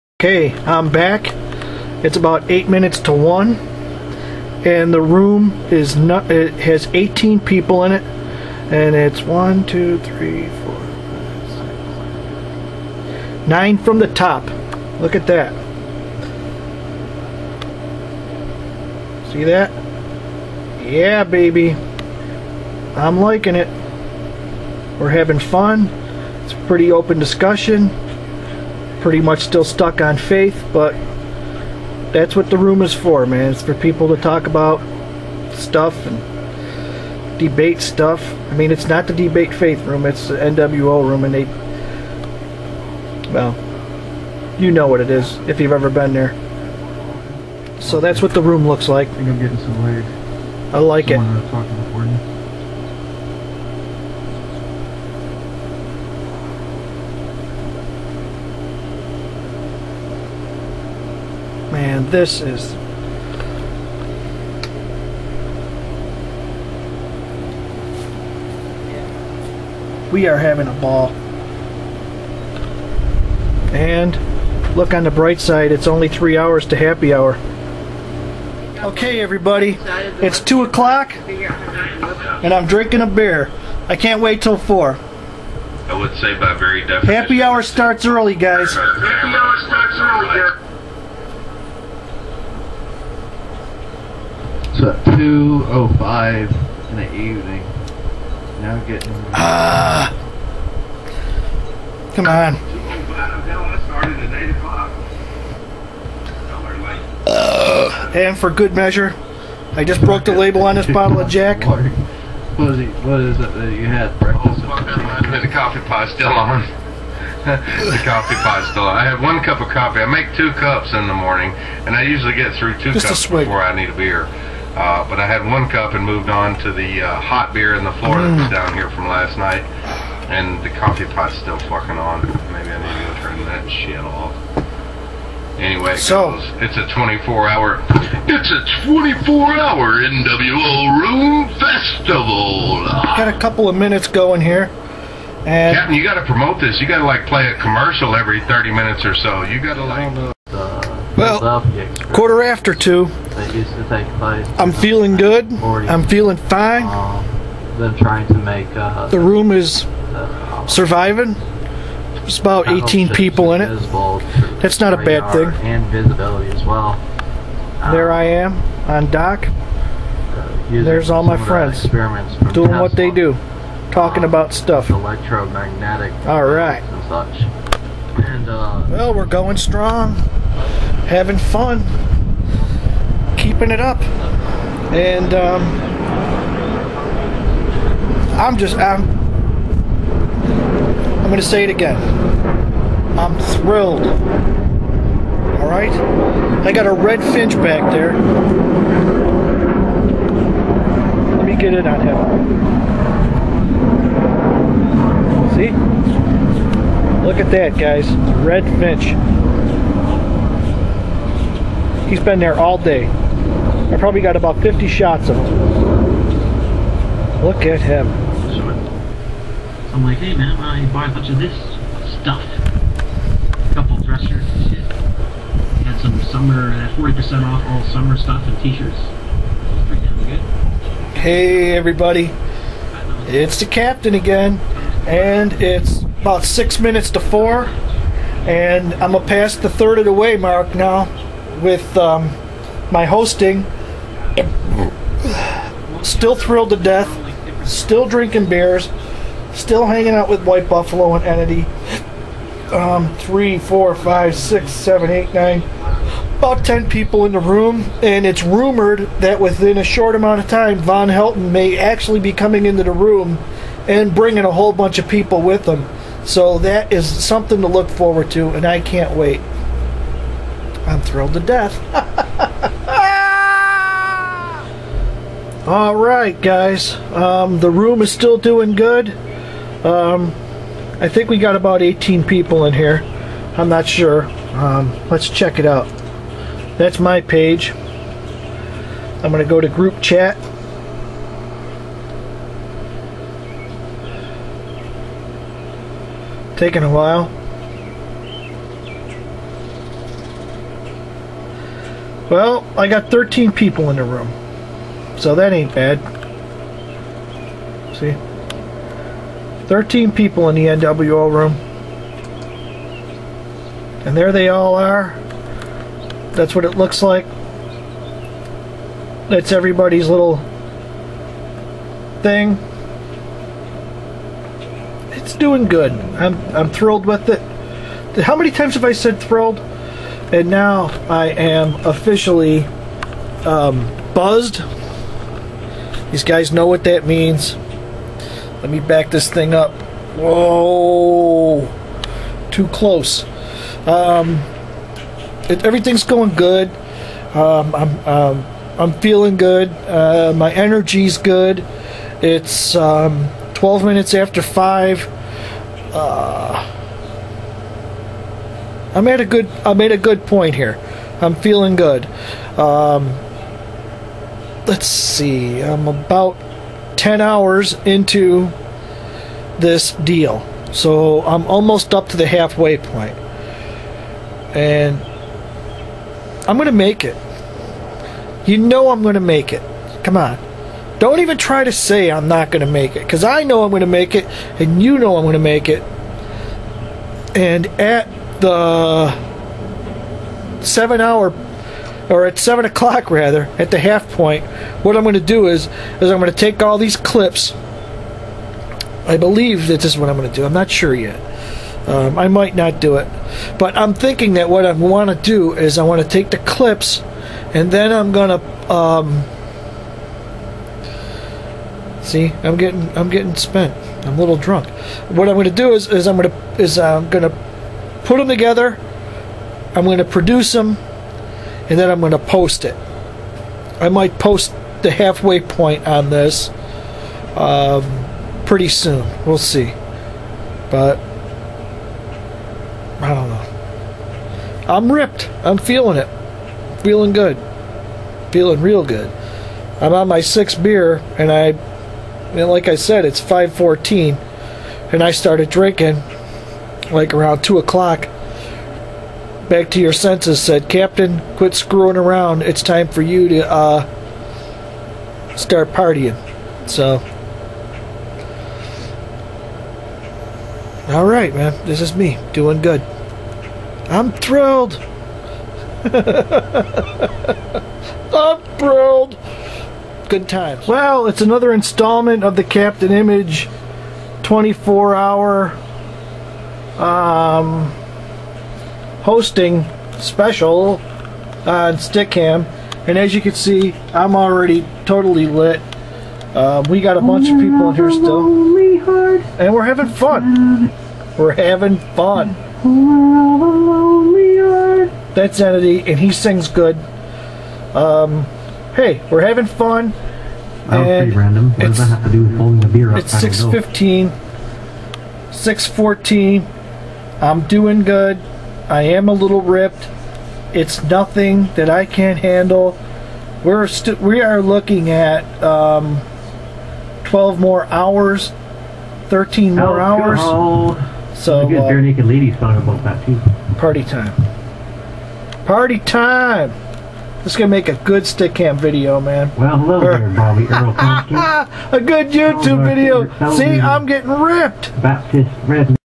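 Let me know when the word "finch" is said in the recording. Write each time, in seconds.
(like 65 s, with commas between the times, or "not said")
197 s, 208 s.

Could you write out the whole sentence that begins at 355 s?
Uh, I made a good I made a good point here.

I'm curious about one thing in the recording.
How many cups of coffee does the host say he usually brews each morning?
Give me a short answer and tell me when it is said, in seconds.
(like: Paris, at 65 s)
2, at 120 s.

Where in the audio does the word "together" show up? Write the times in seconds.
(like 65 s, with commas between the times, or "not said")
418 s.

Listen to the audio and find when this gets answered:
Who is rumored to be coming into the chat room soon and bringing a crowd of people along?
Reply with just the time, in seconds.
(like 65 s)
260 s.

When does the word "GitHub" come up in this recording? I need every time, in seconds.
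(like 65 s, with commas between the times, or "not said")
not said.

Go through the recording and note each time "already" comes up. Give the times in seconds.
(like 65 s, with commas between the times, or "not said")
484 s.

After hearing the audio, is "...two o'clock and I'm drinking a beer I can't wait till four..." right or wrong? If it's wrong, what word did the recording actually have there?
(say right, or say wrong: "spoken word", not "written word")
right.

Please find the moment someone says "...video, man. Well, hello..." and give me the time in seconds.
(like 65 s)
528 s.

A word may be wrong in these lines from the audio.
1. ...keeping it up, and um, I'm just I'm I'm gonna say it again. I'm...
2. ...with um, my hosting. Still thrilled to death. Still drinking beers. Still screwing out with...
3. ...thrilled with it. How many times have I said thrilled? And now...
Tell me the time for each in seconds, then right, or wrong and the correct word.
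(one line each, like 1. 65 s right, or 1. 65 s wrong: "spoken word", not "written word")
1. 183 s right
2. 241 s wrong: "hanging", not "screwing"
3. 326 s right.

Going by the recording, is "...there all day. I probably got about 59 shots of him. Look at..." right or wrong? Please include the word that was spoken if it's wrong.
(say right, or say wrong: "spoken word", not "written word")
wrong: "50", not "59".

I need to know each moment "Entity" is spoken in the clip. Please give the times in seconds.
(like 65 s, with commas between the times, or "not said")
251 s, 495 s.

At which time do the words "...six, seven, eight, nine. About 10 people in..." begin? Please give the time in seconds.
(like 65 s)
254 s.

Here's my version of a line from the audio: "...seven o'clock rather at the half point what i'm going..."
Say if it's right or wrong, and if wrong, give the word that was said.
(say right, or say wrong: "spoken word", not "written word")
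right.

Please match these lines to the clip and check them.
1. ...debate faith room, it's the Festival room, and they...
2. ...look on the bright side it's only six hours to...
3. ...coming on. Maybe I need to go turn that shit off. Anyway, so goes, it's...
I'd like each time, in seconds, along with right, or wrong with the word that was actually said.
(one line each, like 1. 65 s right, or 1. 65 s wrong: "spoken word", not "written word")
1. 39 s wrong: "NWO", not "Festival"
2. 74 s wrong: "three", not "six"
3. 131 s wrong: "fucking", not "coming".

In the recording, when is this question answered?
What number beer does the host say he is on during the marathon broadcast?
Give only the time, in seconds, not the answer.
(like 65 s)
440 s.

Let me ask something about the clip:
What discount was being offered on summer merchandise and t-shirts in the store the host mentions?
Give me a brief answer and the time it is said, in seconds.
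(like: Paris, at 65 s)
40%, at 226 s.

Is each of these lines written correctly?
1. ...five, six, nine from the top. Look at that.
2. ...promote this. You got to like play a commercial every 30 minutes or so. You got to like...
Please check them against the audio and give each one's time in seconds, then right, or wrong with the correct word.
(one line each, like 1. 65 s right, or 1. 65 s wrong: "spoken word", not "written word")
1. 10 s right
2. 146 s right.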